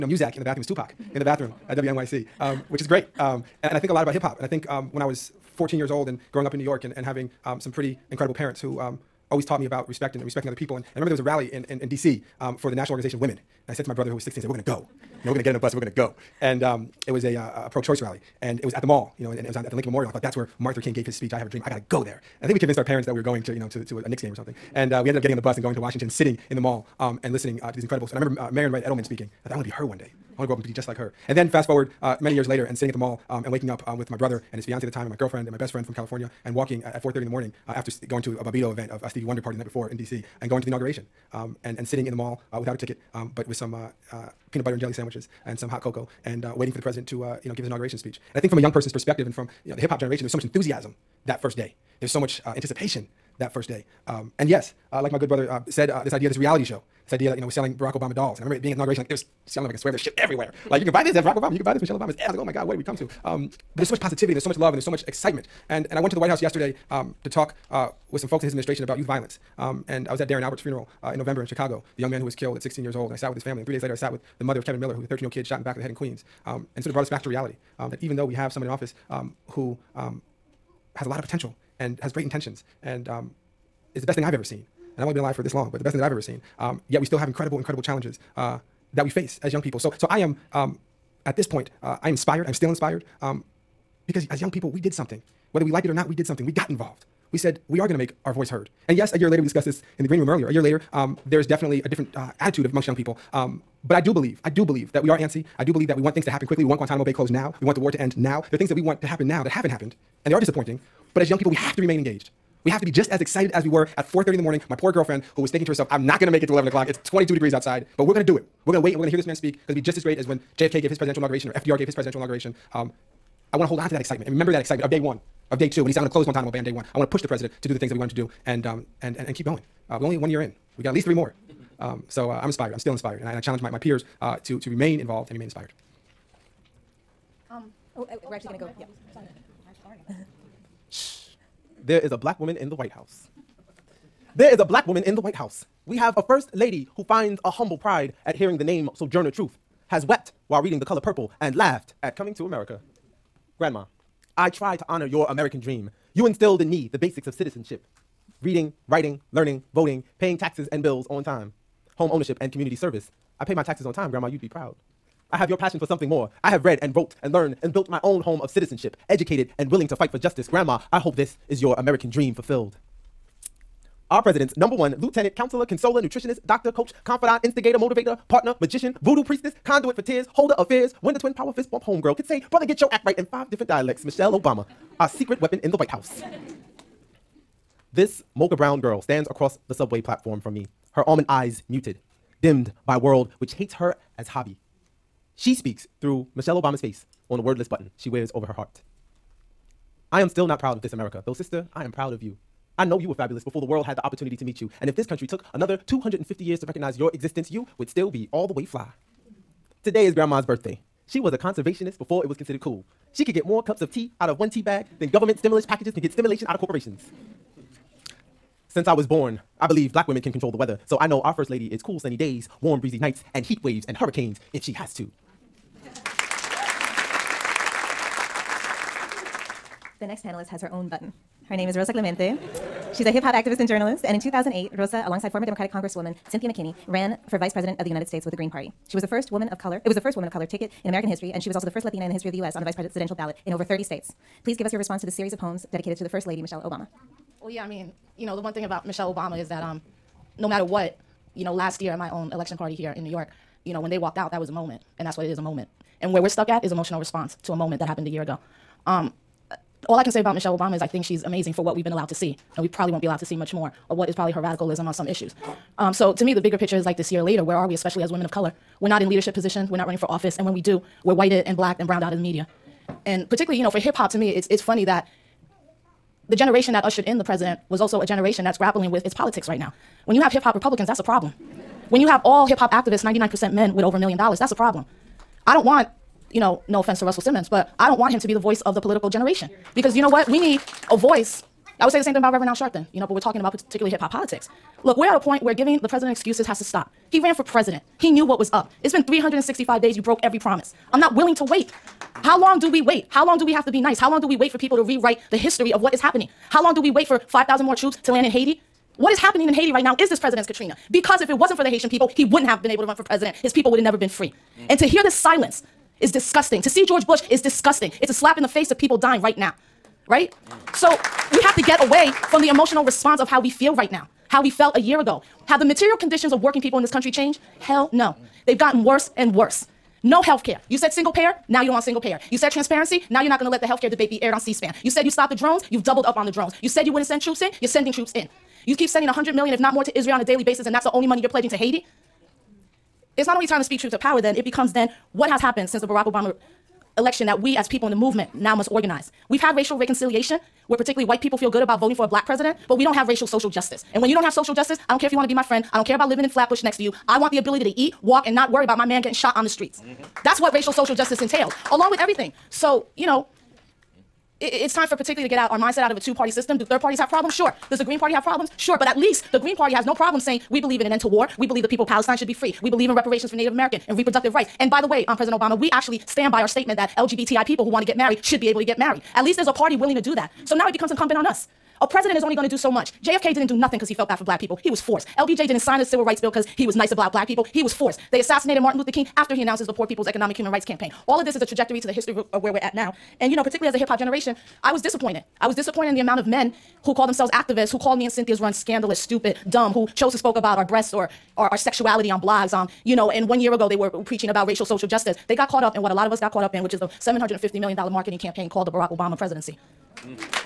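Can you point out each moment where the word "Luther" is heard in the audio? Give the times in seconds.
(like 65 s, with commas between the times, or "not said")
20 s, 388 s.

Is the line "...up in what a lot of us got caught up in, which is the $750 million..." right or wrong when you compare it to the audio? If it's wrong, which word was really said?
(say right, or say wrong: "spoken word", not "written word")
right.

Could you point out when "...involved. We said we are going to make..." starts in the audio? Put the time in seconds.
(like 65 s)
96 s.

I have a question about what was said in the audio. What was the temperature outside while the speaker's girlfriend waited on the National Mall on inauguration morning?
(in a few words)
22 degrees.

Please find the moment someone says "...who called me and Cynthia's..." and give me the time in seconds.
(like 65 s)
397 s.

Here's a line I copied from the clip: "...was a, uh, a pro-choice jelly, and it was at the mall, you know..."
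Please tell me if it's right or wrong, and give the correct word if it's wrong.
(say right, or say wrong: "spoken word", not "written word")
wrong: "rally", not "jelly".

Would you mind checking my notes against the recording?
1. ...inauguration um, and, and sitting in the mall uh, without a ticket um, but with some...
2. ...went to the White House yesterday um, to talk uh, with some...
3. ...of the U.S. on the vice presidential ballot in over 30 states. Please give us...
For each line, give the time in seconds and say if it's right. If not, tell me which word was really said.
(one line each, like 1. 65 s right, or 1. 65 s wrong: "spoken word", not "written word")
1. 40 s right
2. 65 s right
3. 242 s right.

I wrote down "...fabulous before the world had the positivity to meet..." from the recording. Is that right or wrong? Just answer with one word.
wrong.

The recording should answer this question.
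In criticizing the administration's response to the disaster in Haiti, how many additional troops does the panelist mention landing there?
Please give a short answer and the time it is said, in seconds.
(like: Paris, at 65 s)
5,000, at 307 s.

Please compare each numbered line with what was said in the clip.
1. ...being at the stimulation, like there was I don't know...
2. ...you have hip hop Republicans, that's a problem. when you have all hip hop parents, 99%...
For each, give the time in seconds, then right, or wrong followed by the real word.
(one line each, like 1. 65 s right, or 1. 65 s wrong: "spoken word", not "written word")
1. 58 s wrong: "inauguration", not "stimulation"
2. 280 s wrong: "activists", not "parents".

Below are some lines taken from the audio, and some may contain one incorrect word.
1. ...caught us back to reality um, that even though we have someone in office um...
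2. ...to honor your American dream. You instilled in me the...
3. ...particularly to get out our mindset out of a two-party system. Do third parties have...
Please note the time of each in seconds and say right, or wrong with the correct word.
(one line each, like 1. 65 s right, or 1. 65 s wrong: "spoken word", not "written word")
1. 76 s wrong: "brought", not "caught"
2. 154 s right
3. 364 s right.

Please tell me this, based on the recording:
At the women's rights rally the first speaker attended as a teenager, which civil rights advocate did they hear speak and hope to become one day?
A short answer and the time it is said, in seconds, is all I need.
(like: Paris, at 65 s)
Marian Wright Edelman, at 28 s.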